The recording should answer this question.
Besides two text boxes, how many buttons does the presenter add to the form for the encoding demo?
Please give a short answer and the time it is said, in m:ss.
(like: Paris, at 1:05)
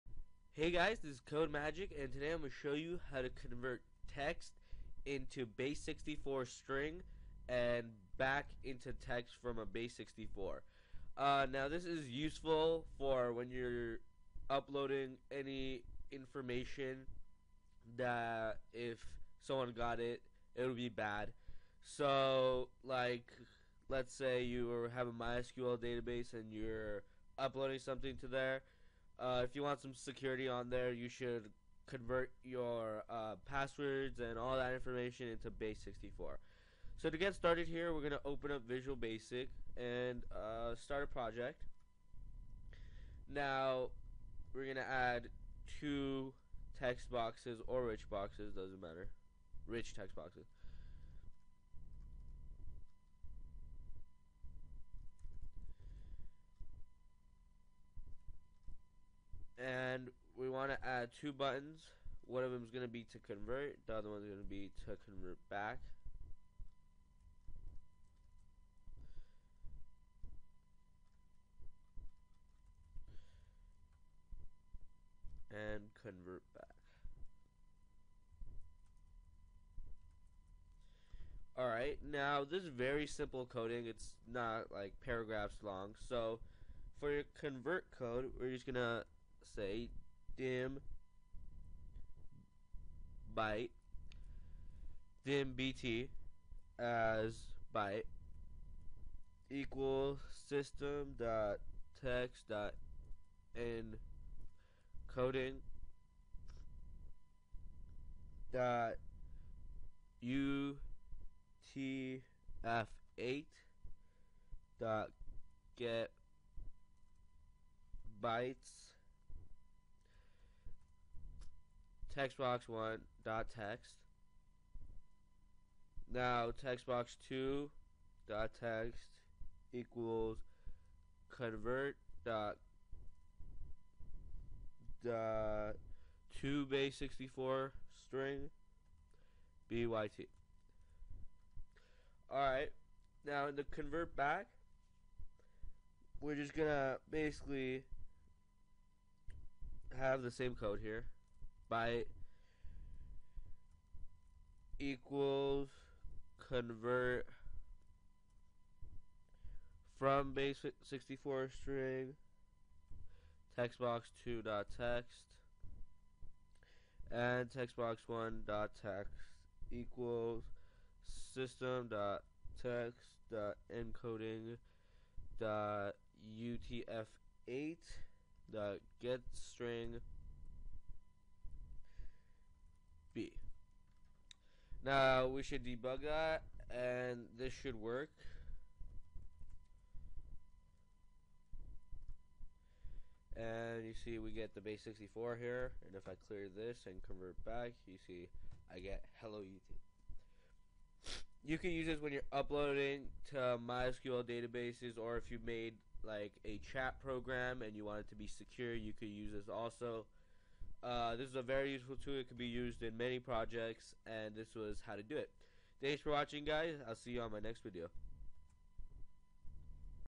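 2, at 1:01.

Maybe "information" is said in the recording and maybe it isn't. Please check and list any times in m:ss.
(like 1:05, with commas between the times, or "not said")
0:16, 0:34.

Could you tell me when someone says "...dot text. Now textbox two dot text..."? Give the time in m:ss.
2:03.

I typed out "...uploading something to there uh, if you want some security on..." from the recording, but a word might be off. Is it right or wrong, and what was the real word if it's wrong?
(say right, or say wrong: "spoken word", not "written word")
right.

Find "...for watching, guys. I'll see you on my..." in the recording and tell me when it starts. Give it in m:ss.
3:36.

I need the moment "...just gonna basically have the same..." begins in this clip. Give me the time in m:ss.
2:26.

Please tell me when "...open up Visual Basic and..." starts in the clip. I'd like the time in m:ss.
0:38.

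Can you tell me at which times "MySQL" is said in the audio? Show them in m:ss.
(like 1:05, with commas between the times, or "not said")
0:25, 3:23.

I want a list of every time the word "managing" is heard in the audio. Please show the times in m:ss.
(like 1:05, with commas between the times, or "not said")
not said.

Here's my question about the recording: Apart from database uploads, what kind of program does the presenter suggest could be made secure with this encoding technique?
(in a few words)
A chat program.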